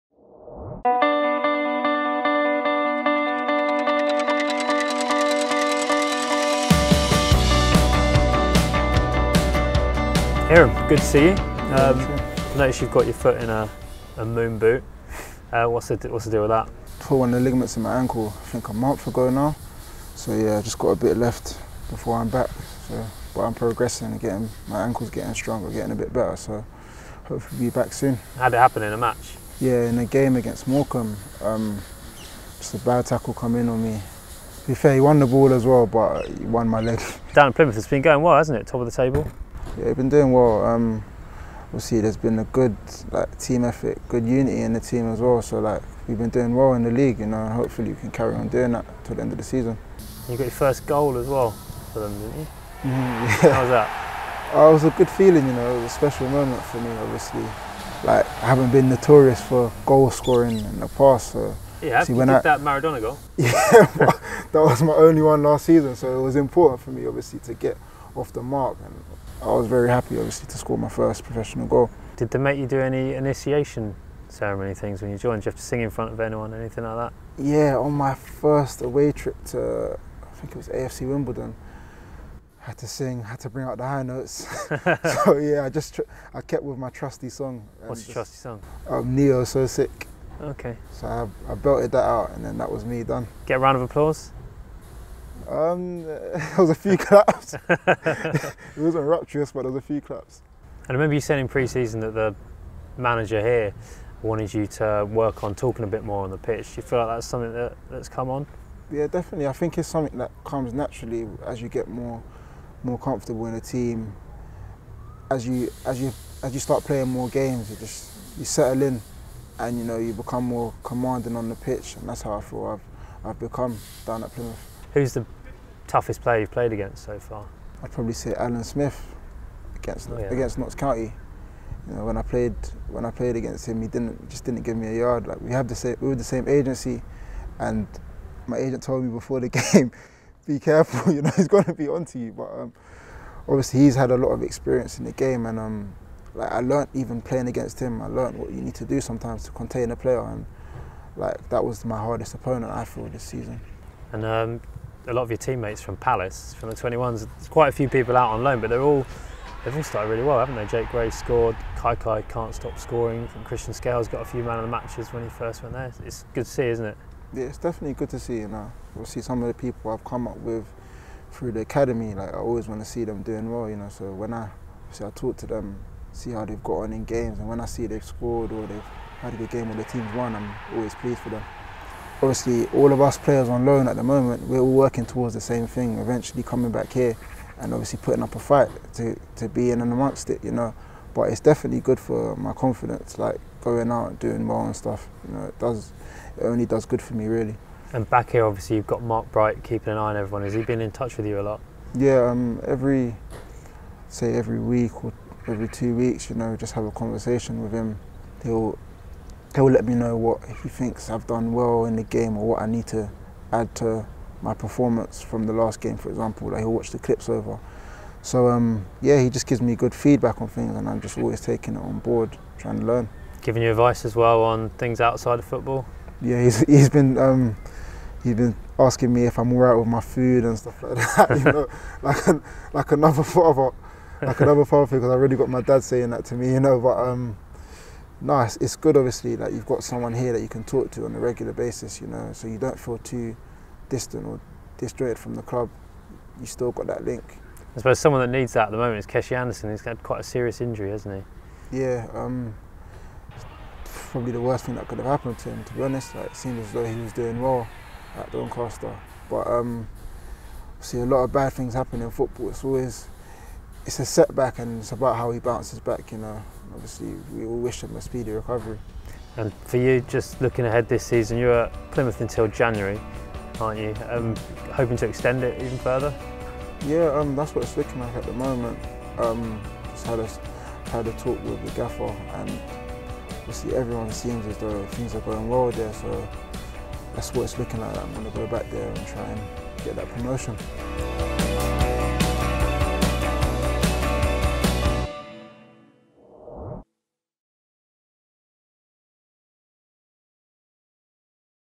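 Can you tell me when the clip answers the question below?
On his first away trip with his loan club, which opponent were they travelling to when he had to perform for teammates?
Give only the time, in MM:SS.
01:20.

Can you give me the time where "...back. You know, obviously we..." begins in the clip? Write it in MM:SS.
04:25.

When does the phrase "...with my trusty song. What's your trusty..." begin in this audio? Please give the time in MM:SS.
01:26.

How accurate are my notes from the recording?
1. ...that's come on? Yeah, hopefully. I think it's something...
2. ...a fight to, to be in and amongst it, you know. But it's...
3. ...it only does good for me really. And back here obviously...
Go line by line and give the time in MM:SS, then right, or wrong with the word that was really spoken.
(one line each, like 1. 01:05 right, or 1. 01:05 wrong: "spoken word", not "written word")
1. 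01:47 wrong: "definitely", not "hopefully"
2. 03:08 right
3. 03:16 right.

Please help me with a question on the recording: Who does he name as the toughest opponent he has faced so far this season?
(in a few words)
Alan Smith.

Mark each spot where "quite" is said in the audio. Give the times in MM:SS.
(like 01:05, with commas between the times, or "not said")
02:37, 04:10.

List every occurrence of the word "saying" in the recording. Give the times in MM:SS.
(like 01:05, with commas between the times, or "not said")
01:41, 03:55.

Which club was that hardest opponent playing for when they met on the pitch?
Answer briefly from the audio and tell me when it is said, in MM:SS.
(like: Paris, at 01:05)
Notts County, at 02:10.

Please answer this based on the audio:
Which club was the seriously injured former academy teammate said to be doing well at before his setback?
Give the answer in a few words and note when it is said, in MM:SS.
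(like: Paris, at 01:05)
Doncaster, at 04:18.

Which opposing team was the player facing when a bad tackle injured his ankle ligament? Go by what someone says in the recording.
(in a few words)
Morecambe.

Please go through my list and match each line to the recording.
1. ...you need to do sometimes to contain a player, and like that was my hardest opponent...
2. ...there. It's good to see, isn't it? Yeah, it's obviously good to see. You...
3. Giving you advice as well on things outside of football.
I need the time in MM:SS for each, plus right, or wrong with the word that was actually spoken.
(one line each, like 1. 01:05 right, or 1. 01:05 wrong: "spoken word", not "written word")
1. 02:28 right
2. 02:45 wrong: "definitely", not "obviously"
3. 03:43 right.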